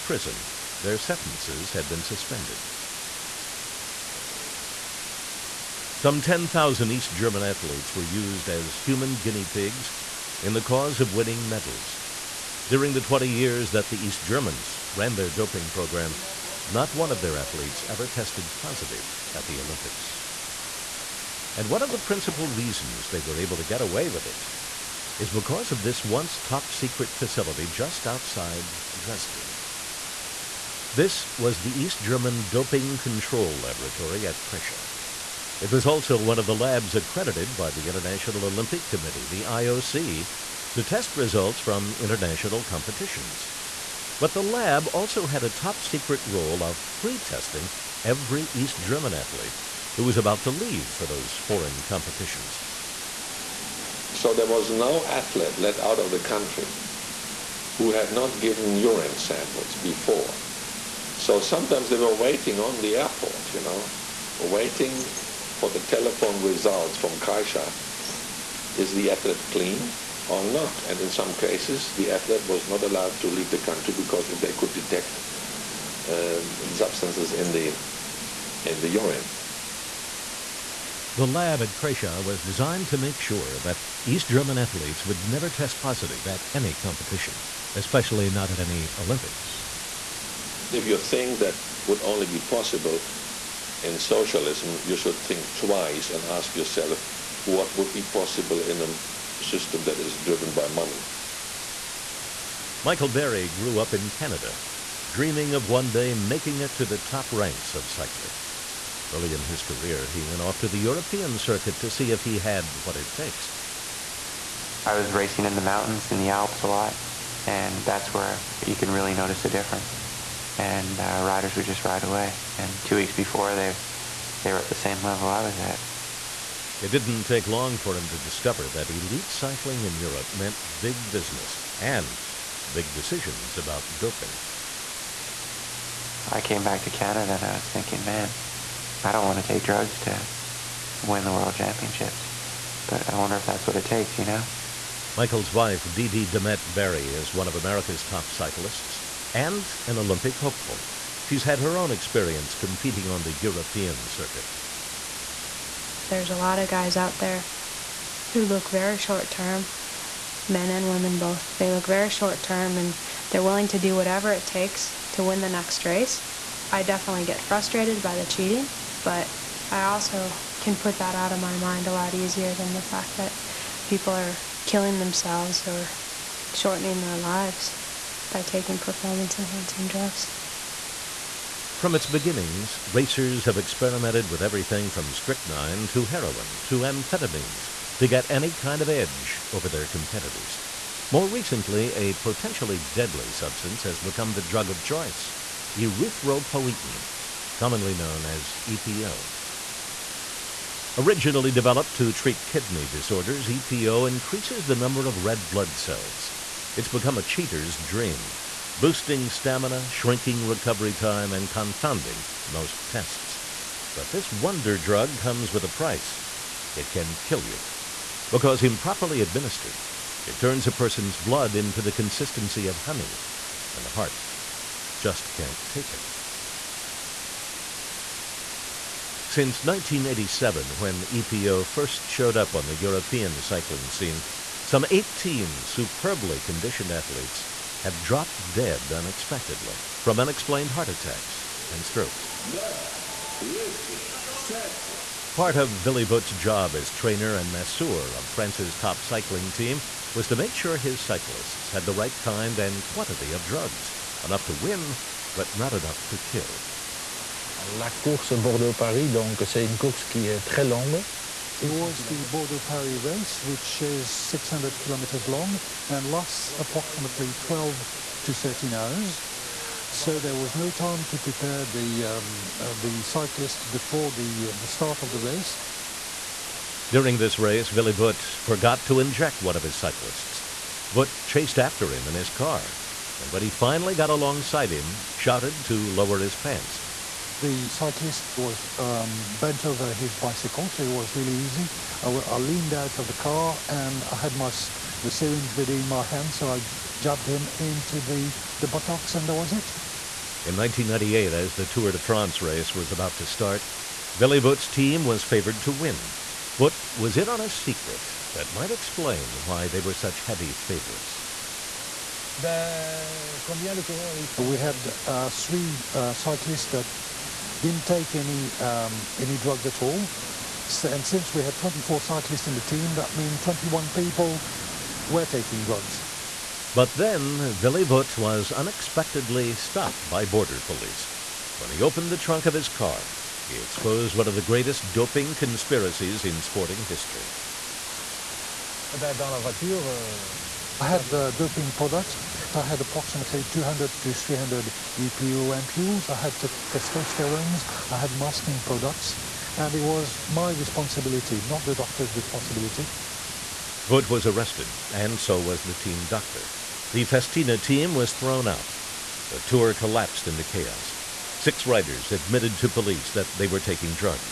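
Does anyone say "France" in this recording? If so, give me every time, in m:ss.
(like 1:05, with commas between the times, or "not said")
4:08, 5:01.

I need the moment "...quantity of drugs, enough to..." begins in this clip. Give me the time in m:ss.
4:12.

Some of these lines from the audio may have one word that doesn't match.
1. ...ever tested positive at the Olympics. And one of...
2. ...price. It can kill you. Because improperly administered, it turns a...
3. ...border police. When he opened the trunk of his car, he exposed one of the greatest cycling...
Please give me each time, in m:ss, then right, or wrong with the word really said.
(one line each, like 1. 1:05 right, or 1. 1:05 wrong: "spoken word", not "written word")
1. 0:17 right
2. 3:35 right
3. 5:30 wrong: "doping", not "cycling".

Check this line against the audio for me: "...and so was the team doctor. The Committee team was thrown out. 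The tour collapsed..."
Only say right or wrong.
wrong.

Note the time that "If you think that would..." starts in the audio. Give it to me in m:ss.
1:30.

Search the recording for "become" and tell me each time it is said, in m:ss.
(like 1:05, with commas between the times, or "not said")
3:13, 3:26.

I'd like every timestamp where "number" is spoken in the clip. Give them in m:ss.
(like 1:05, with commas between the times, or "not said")
3:24.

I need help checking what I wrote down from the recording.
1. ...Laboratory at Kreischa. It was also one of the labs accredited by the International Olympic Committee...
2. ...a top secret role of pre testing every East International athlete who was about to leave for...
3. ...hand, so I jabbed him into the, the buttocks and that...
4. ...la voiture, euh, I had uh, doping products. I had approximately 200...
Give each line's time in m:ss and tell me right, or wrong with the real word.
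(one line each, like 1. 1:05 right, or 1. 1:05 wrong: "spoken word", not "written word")
1. 0:33 right
2. 0:45 wrong: "German", not "International"
3. 4:56 right
4. 5:39 right.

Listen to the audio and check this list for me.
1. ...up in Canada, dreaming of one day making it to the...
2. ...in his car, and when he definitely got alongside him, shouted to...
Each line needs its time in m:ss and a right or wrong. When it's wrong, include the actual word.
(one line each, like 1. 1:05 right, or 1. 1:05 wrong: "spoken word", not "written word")
1. 1:43 right
2. 4:42 wrong: "finally", not "definitely".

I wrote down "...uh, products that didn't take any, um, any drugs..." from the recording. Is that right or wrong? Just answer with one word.
wrong.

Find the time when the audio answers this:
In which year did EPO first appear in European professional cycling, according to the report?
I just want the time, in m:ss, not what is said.
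3:49.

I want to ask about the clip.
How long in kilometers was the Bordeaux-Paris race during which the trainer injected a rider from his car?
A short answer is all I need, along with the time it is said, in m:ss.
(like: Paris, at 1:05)
600 kilometers, at 4:24.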